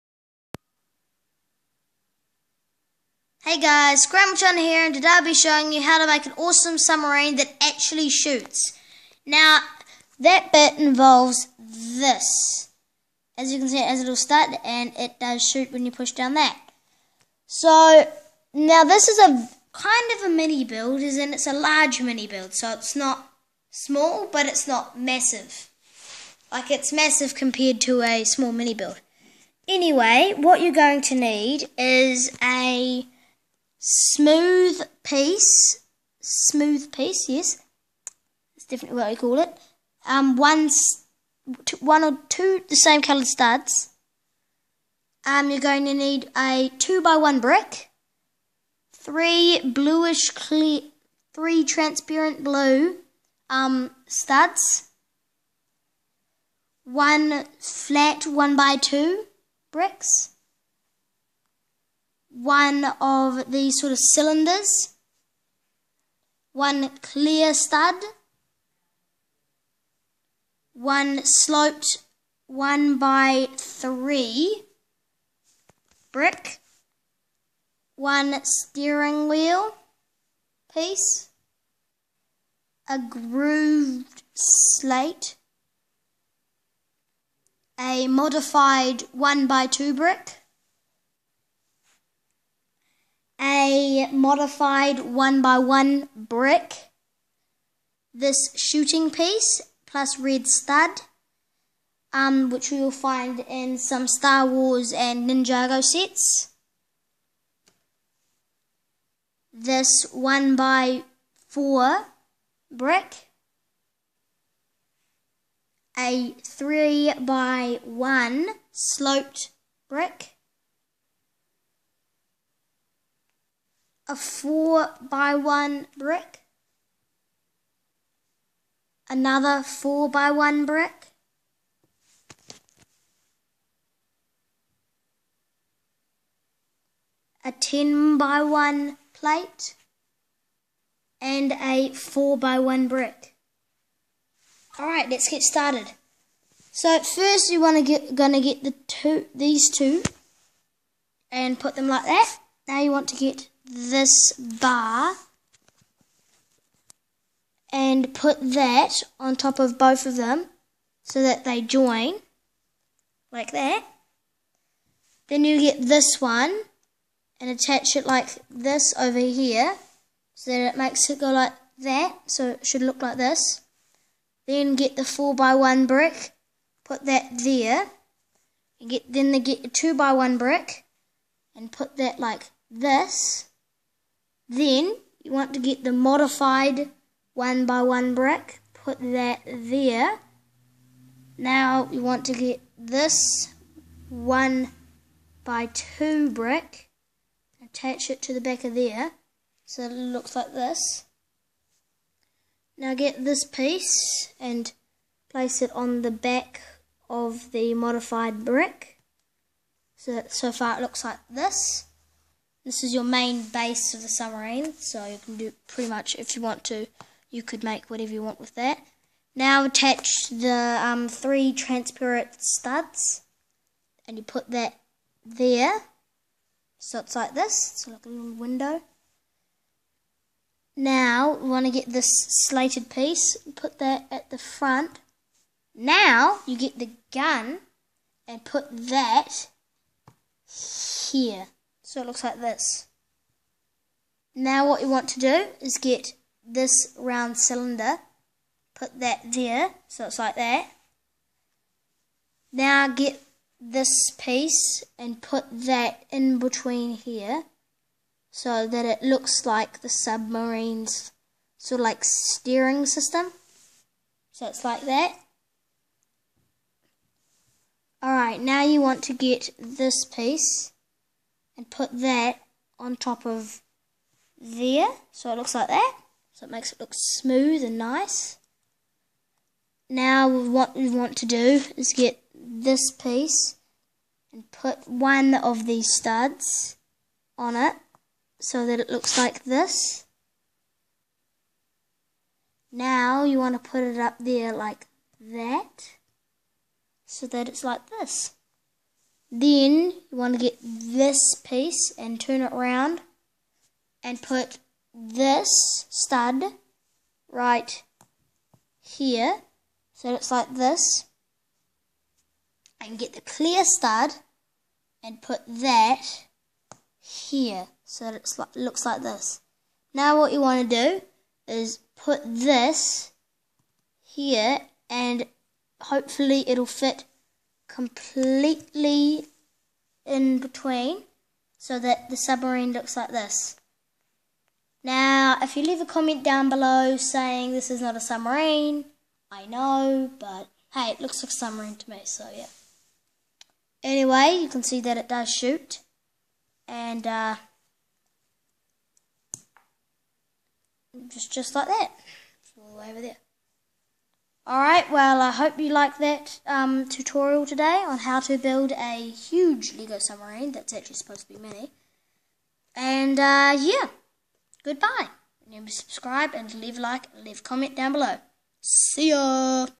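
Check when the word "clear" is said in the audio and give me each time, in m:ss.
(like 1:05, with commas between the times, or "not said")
0:50, 1:07, 5:13.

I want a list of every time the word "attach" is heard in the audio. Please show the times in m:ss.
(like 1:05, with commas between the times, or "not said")
2:47, 3:17, 3:39.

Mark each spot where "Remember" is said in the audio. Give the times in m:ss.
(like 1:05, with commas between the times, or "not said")
6:05.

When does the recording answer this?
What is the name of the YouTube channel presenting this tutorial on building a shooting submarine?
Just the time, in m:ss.
0:04.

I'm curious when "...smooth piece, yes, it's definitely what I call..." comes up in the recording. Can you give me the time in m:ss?
0:36.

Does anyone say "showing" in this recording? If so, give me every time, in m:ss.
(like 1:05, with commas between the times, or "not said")
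0:05.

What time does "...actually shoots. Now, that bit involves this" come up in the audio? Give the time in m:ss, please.
0:07.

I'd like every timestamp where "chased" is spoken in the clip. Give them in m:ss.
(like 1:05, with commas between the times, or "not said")
not said.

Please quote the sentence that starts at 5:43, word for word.
Anyway, you can see that it does shoot.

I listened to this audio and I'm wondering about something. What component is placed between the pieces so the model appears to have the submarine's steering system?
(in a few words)
steering wheel piece.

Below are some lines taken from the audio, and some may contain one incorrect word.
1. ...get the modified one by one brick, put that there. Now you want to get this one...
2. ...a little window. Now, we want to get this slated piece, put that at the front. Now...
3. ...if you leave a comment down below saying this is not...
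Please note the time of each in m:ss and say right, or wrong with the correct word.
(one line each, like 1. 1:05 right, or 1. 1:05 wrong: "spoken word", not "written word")
1. 3:05 right
2. 3:48 right
3. 5:35 right.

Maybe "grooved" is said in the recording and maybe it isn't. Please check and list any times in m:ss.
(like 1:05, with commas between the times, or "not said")
1:22.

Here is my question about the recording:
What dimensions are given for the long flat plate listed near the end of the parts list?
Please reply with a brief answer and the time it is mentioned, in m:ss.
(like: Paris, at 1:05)
10 by 1, at 2:17.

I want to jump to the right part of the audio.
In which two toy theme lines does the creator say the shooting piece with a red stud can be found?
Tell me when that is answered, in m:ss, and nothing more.
1:44.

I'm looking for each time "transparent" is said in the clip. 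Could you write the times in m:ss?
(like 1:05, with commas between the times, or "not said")
0:51, 3:41.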